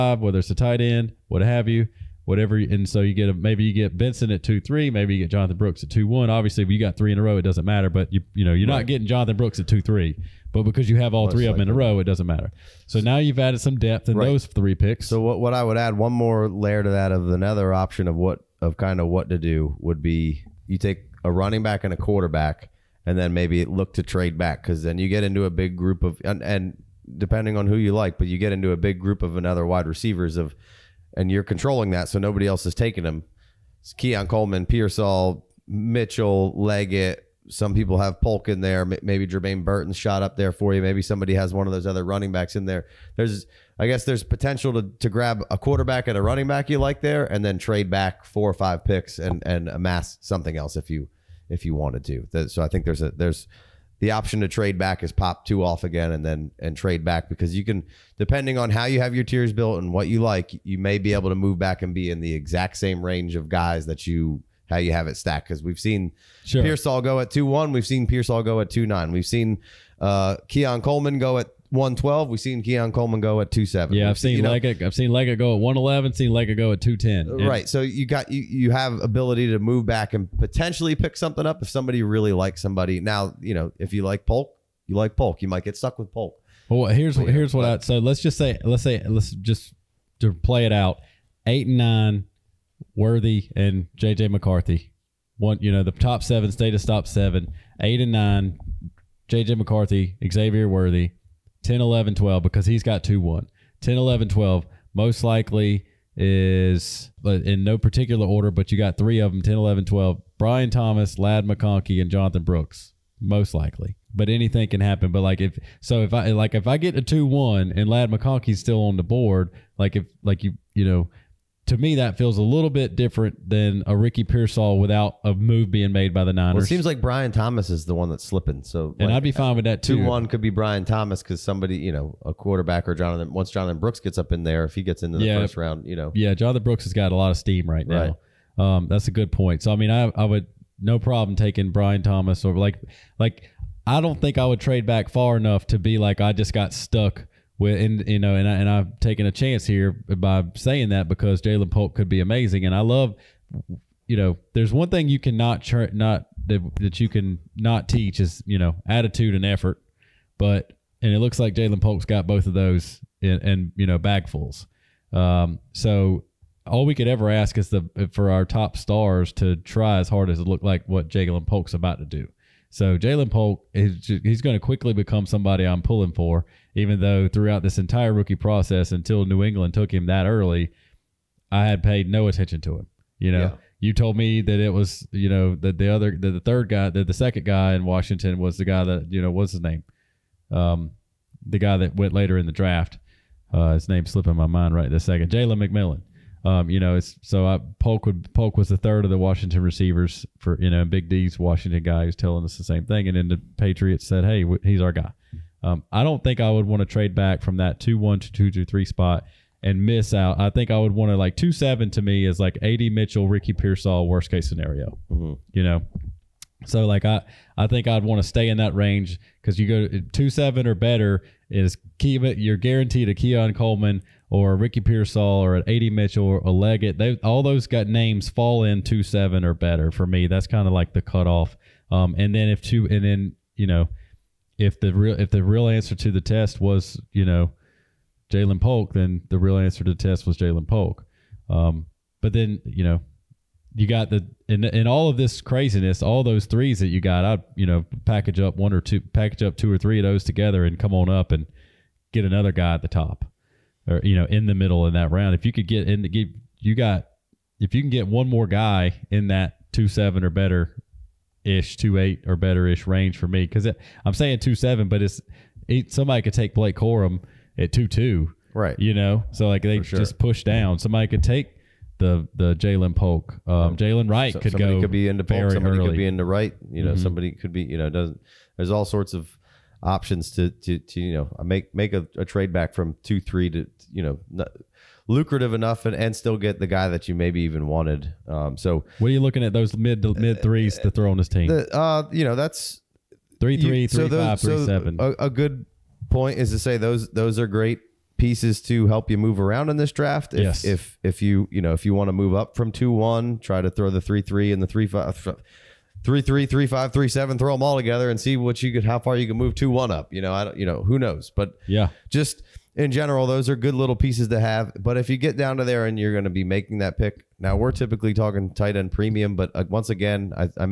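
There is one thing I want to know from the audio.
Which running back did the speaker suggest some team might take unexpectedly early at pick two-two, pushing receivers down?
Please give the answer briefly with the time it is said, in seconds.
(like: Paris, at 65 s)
Blake Corum, at 266 s.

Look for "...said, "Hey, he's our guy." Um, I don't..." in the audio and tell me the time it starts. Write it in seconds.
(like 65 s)
204 s.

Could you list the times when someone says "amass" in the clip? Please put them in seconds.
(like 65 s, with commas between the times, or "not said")
49 s.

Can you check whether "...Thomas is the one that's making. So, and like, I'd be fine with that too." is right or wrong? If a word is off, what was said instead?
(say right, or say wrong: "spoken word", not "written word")
wrong: "slipping", not "making".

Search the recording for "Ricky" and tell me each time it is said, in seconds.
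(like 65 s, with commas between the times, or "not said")
123 s, 213 s, 224 s.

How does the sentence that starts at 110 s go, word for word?
Brian Thomas, Ladd McConkey, and Jonathan Brooks, most likely.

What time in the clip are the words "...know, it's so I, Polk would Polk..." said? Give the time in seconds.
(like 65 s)
196 s.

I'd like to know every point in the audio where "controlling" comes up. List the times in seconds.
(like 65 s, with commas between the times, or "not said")
31 s.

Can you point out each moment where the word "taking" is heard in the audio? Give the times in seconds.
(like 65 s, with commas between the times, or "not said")
32 s, 141 s.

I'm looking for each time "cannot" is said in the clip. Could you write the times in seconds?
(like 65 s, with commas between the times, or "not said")
155 s.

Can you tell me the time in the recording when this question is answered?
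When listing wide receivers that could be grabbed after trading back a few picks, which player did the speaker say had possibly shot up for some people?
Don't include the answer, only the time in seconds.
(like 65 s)
39 s.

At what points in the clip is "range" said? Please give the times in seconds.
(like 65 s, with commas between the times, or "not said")
63 s, 218 s, 262 s.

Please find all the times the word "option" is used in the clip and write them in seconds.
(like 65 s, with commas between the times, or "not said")
17 s, 54 s, 279 s.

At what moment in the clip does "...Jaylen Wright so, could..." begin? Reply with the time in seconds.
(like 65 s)
273 s.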